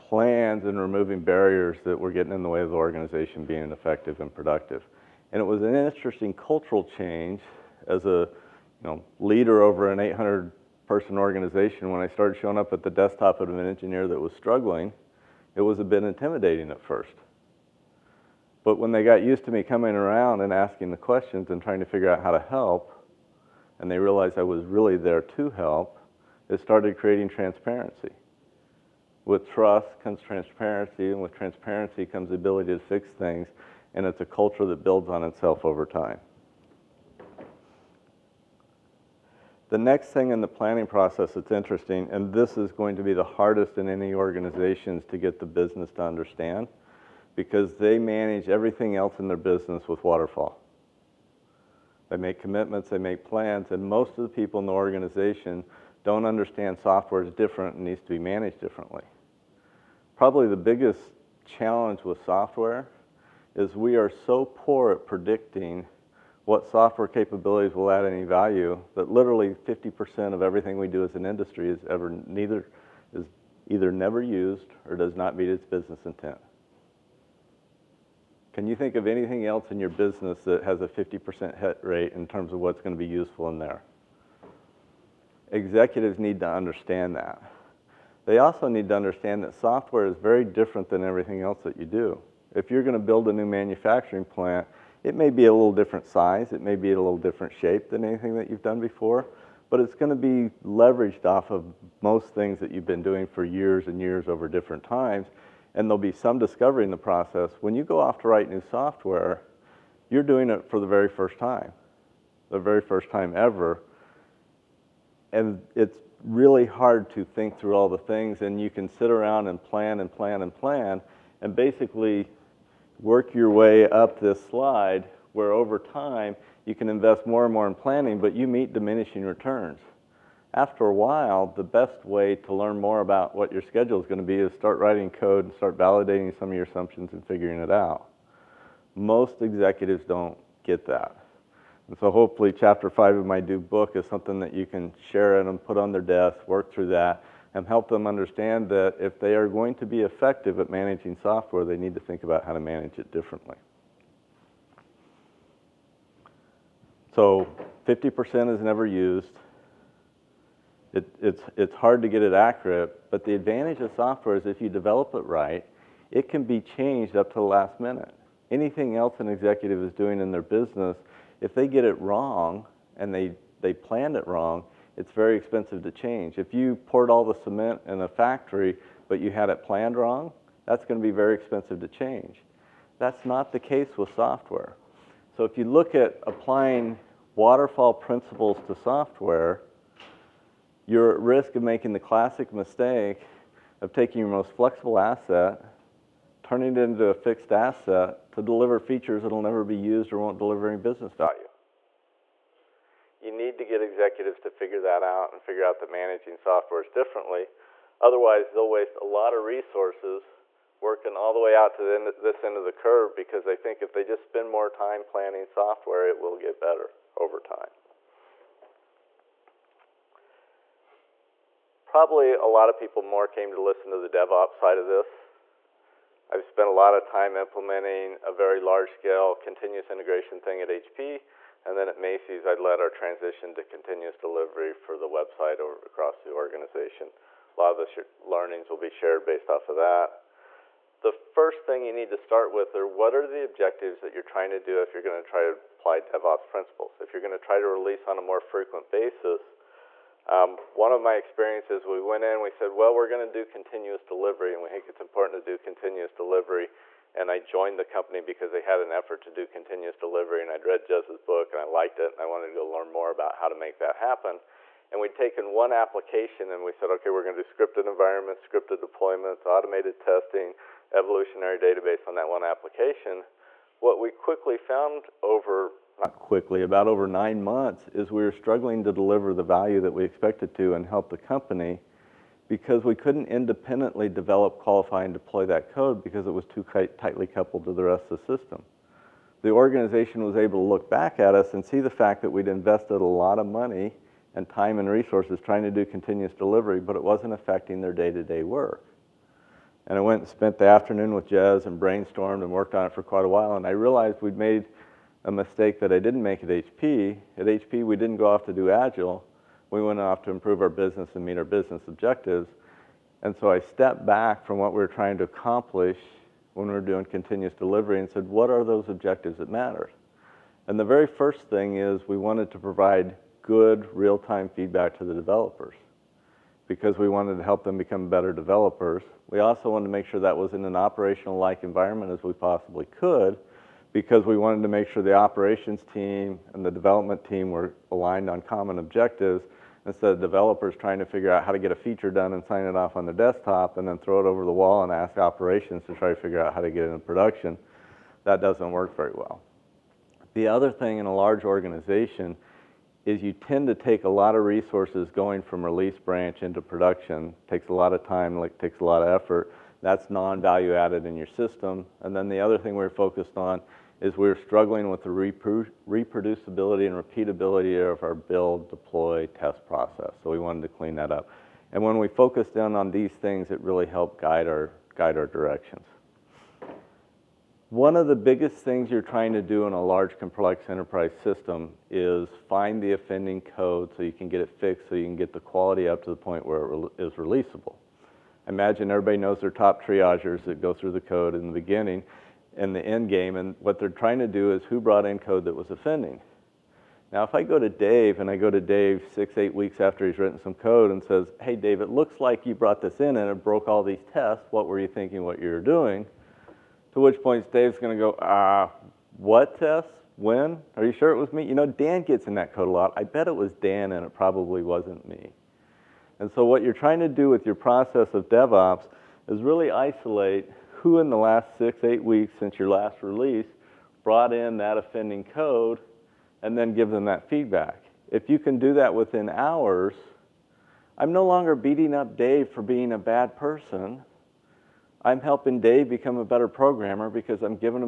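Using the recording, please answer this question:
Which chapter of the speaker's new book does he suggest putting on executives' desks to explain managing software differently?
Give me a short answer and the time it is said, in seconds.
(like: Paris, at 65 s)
Chapter five, at 142 s.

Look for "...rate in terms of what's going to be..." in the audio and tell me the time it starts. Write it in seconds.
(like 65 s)
81 s.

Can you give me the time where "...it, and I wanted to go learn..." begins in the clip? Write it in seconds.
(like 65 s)
261 s.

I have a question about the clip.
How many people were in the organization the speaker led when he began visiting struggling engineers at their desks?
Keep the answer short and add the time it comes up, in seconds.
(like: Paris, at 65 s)
800, at 9 s.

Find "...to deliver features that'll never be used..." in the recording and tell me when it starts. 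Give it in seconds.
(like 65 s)
198 s.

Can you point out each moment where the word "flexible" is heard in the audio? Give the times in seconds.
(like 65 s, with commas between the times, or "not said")
194 s.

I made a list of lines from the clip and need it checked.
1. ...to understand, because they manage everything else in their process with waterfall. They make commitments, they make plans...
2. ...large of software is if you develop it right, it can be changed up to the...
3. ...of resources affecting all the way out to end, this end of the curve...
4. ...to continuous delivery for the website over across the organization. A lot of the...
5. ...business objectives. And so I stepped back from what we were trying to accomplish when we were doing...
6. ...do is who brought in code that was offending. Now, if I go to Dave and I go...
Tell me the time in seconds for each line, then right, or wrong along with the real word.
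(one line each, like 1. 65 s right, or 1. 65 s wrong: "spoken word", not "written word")
1. 45 s wrong: "business", not "process"
2. 163 s wrong: "advantage", not "large"
3. 209 s wrong: "working", not "affecting"
4. 233 s right
5. 311 s right
6. 394 s right.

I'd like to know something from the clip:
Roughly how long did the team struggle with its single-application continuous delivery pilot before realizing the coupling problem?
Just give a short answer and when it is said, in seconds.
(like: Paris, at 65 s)
9 months, at 277 s.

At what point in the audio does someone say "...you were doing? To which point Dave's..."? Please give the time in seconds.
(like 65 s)
405 s.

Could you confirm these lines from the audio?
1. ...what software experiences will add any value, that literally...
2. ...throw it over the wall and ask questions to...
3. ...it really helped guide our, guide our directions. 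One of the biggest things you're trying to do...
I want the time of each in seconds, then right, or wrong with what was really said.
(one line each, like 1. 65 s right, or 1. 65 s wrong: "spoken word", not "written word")
1. 66 s wrong: "capabilities", not "experiences"
2. 343 s wrong: "operations", not "questions"
3. 373 s right.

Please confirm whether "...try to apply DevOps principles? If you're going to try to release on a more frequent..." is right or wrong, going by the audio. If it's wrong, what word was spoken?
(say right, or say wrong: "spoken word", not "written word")
right.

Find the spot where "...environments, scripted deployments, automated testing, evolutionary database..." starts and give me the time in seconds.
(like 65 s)
267 s.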